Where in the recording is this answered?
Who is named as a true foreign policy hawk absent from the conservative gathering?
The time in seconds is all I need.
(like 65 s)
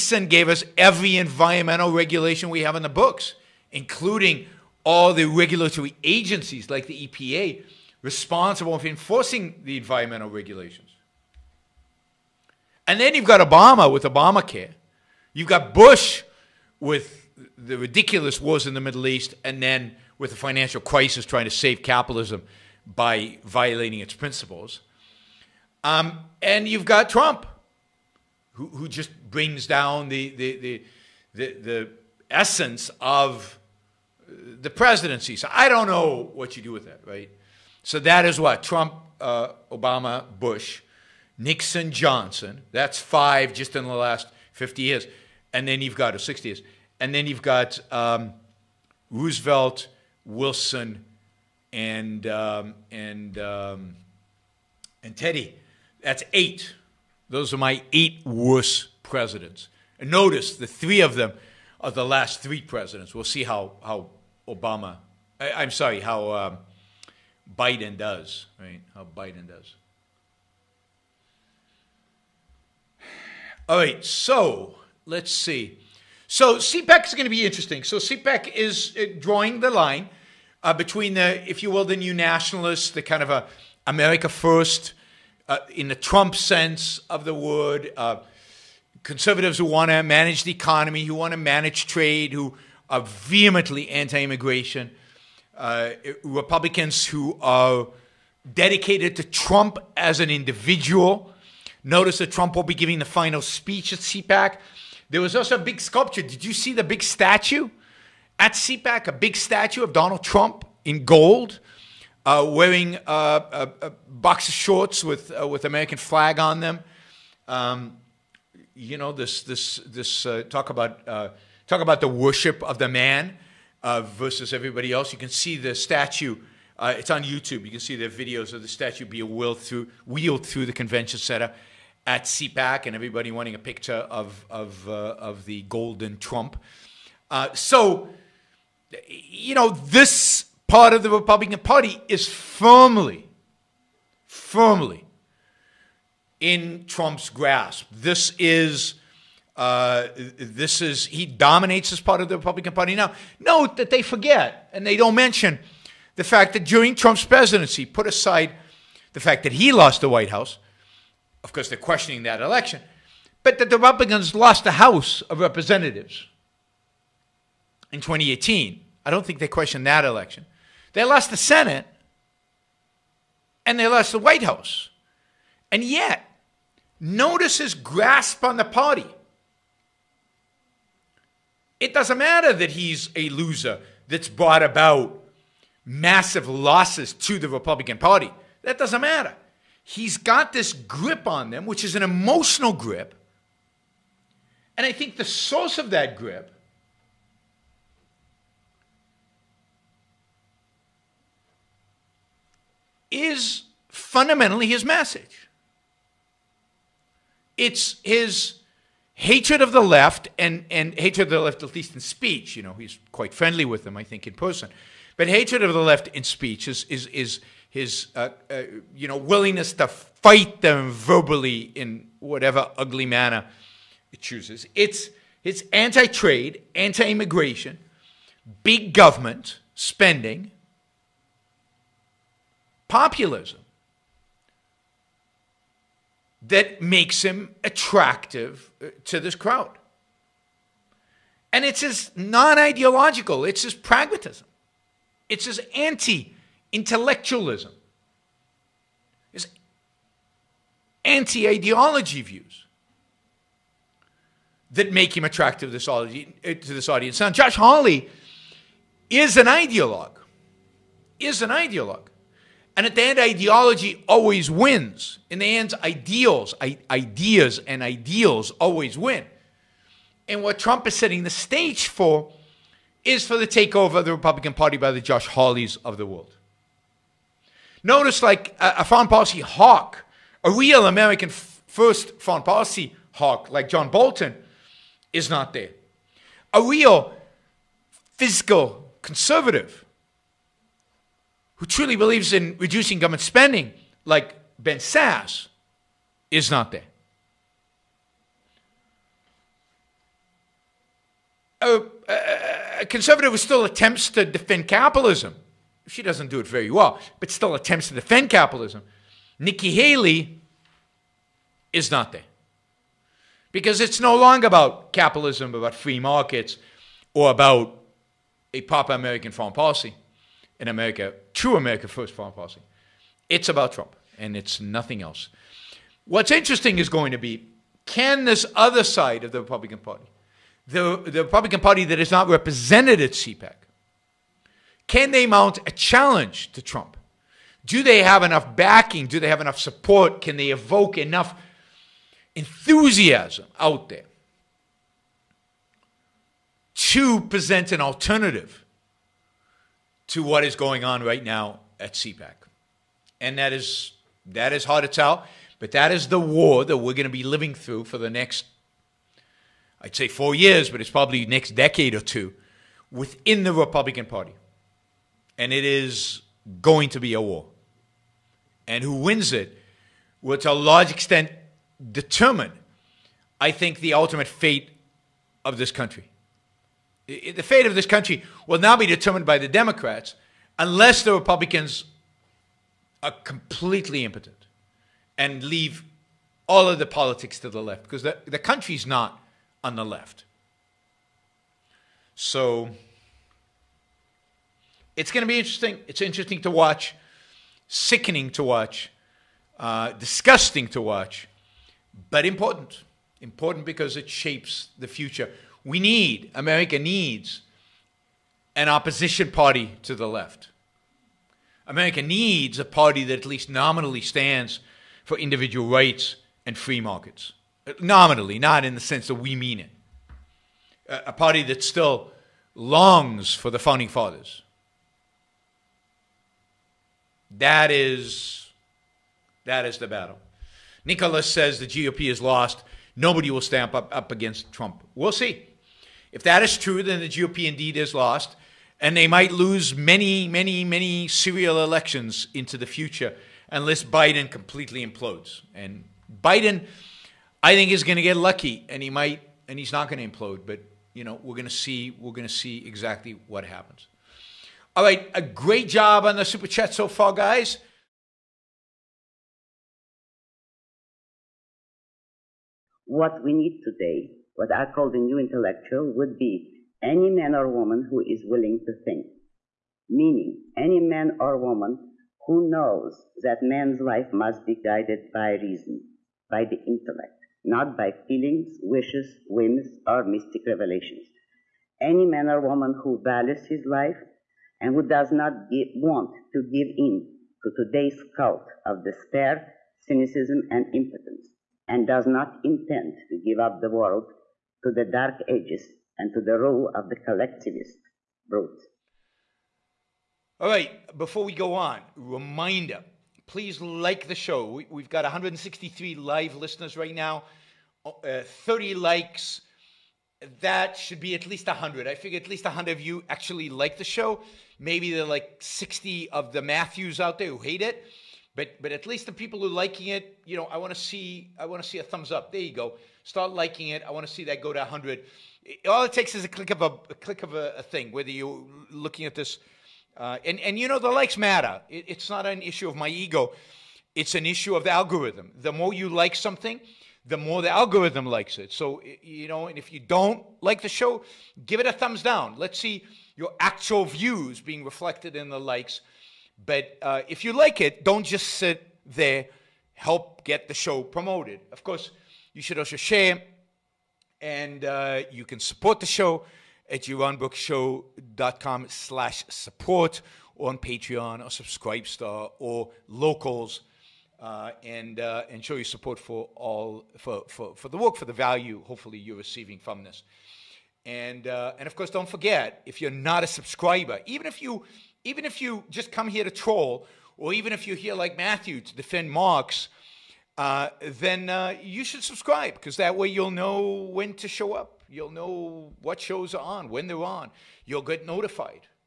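283 s.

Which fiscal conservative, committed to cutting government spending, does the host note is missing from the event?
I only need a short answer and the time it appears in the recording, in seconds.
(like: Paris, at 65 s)
Ben Sasse, at 294 s.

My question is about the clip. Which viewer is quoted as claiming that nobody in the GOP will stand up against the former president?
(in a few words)
Nicholas.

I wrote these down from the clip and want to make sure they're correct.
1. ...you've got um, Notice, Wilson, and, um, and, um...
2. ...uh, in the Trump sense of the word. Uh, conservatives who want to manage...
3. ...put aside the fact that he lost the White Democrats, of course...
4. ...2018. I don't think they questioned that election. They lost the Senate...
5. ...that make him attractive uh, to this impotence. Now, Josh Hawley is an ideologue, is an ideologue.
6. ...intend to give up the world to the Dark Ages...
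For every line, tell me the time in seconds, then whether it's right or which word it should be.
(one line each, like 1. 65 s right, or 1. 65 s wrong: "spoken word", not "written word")
1. 47 s wrong: "Roosevelt", not "Notice"
2. 85 s right
3. 157 s wrong: "House", not "Democrats"
4. 168 s right
5. 254 s wrong: "audience", not "impotence"
6. 492 s right.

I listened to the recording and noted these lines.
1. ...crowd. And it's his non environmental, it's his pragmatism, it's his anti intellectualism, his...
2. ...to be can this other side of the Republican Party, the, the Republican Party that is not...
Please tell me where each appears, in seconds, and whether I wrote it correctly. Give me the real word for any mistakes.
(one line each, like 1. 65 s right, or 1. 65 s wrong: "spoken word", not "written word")
1. 239 s wrong: "ideological", not "environmental"
2. 327 s right.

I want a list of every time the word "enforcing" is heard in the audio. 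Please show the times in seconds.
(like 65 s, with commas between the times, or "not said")
8 s.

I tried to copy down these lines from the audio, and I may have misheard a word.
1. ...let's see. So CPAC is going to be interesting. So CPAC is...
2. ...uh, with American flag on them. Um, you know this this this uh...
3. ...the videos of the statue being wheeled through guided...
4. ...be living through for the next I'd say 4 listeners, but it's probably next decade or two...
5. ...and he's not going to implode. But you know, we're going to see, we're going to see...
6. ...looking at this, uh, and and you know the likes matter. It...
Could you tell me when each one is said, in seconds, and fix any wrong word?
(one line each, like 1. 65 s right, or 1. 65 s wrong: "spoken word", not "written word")
1. 75 s right
2. 115 s right
3. 127 s wrong: "wheeled", not "guided"
4. 357 s wrong: "years", not "listeners"
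5. 449 s right
6. 528 s right.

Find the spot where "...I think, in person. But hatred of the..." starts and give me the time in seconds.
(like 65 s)
213 s.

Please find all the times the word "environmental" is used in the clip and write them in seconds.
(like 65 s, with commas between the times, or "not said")
1 s, 9 s.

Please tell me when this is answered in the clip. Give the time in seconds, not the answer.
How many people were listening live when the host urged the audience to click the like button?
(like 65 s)
505 s.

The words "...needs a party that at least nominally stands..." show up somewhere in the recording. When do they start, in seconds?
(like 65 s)
412 s.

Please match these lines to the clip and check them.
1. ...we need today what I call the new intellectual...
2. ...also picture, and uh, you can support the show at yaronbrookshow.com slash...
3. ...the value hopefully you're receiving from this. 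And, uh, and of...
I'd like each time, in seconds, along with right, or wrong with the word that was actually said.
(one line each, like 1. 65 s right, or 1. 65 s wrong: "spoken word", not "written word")
1. 463 s right
2. 552 s wrong: "share", not "picture"
3. 568 s right.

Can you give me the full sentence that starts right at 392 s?
So it's going to be interesting.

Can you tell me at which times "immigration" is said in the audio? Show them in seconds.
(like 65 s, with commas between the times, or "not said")
94 s, 226 s.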